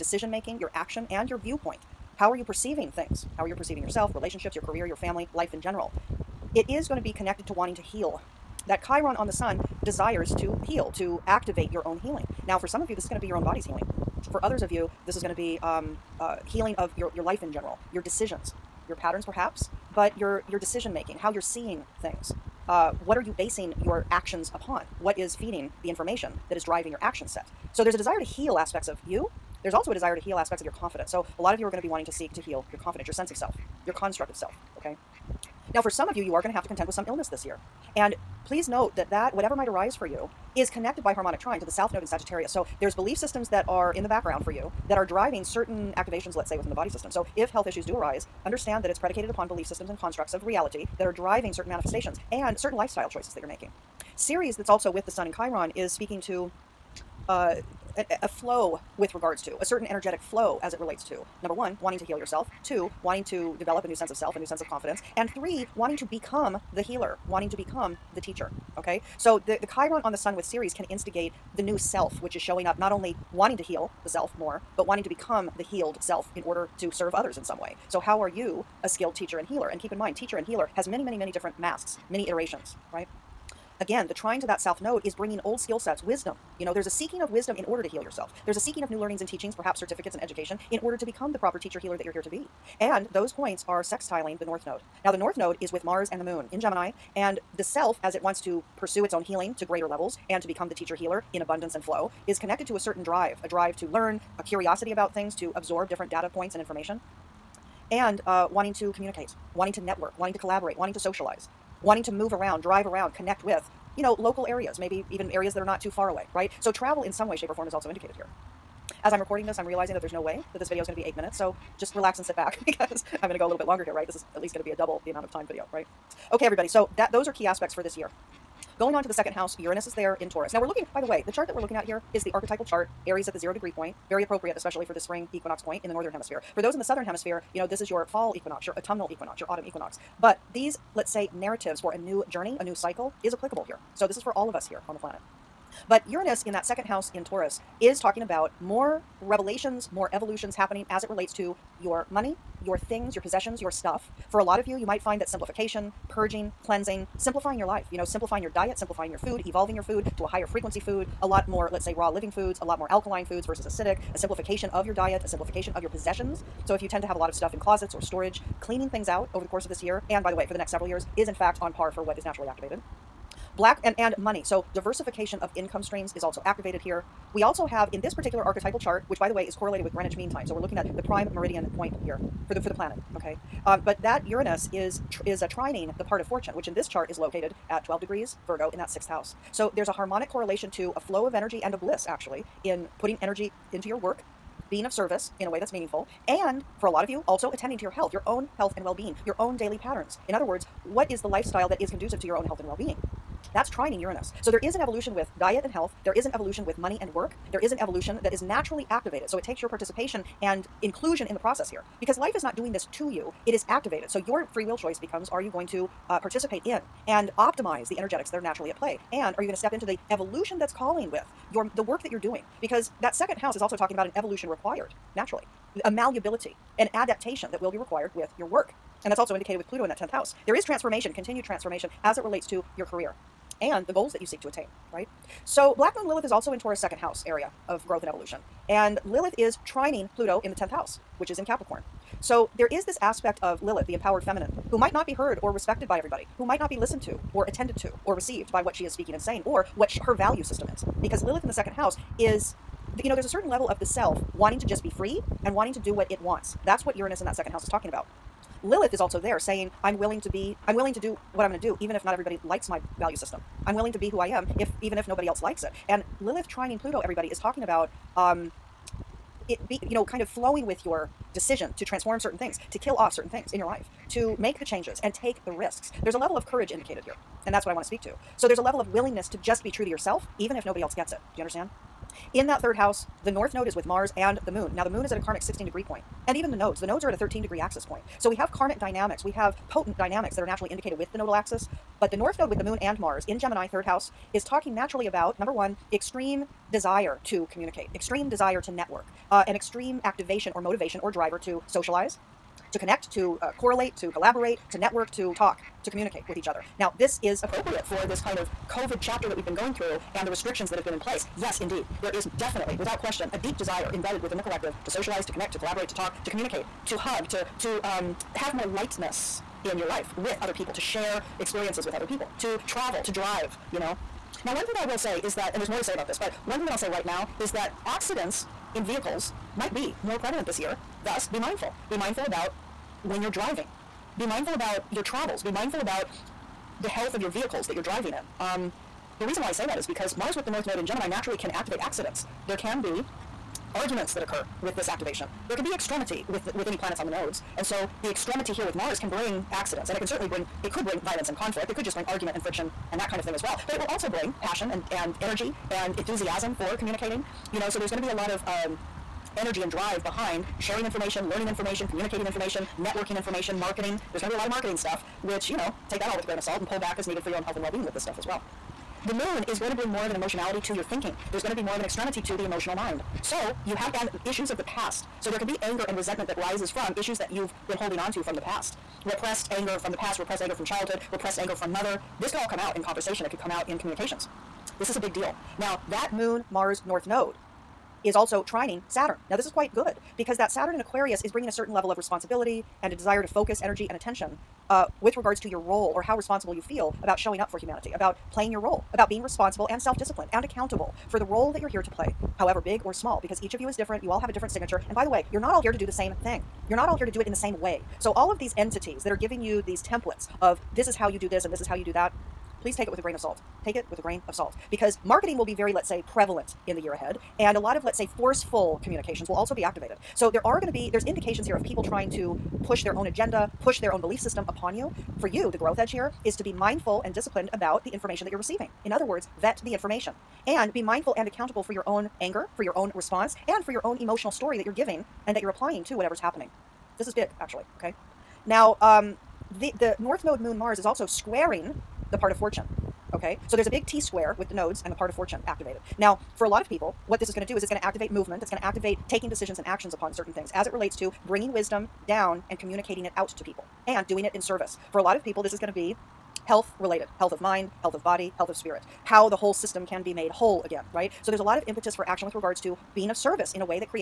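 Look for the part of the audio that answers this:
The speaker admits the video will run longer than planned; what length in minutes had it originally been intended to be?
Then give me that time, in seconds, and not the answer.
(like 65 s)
121 s.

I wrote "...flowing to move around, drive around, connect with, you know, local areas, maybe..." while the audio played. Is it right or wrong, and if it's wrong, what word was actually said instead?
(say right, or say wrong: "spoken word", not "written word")
wrong: "wanting", not "flowing".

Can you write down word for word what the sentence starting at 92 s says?
And those points are sextiling the north node.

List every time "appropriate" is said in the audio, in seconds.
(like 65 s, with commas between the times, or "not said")
134 s, 307 s.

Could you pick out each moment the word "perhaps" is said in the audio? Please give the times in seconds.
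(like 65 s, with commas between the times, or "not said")
19 s, 89 s.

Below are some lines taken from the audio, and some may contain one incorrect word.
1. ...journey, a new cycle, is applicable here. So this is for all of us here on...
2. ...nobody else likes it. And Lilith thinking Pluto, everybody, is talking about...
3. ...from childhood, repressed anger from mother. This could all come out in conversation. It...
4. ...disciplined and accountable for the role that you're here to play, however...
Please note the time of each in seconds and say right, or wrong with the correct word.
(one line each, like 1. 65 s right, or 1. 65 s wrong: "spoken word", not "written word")
1. 142 s right
2. 265 s wrong: "trining", not "thinking"
3. 380 s right
4. 399 s right.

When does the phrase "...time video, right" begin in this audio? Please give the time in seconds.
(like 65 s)
125 s.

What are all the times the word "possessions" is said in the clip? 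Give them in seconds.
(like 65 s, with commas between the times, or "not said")
153 s, 165 s.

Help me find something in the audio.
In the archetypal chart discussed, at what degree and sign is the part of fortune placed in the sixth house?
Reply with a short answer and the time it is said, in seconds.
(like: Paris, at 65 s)
12 degrees Virgo, at 187 s.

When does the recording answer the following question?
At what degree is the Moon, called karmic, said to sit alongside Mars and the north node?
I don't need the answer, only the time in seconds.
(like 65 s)
285 s.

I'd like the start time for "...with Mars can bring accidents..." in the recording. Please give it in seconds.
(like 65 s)
348 s.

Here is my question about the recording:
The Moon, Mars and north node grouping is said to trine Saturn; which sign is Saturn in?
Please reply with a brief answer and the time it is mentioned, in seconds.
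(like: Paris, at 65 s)
Aquarius, at 390 s.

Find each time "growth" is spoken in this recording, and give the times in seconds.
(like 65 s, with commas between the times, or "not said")
237 s, 425 s.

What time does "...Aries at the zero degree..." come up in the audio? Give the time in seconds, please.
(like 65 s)
133 s.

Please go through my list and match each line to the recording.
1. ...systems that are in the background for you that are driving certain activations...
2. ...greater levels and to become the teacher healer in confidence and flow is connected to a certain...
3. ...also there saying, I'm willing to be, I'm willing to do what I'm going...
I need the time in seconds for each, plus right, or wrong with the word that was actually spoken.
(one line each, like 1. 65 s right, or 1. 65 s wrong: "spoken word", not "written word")
1. 43 s right
2. 99 s wrong: "abundance", not "confidence"
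3. 259 s right.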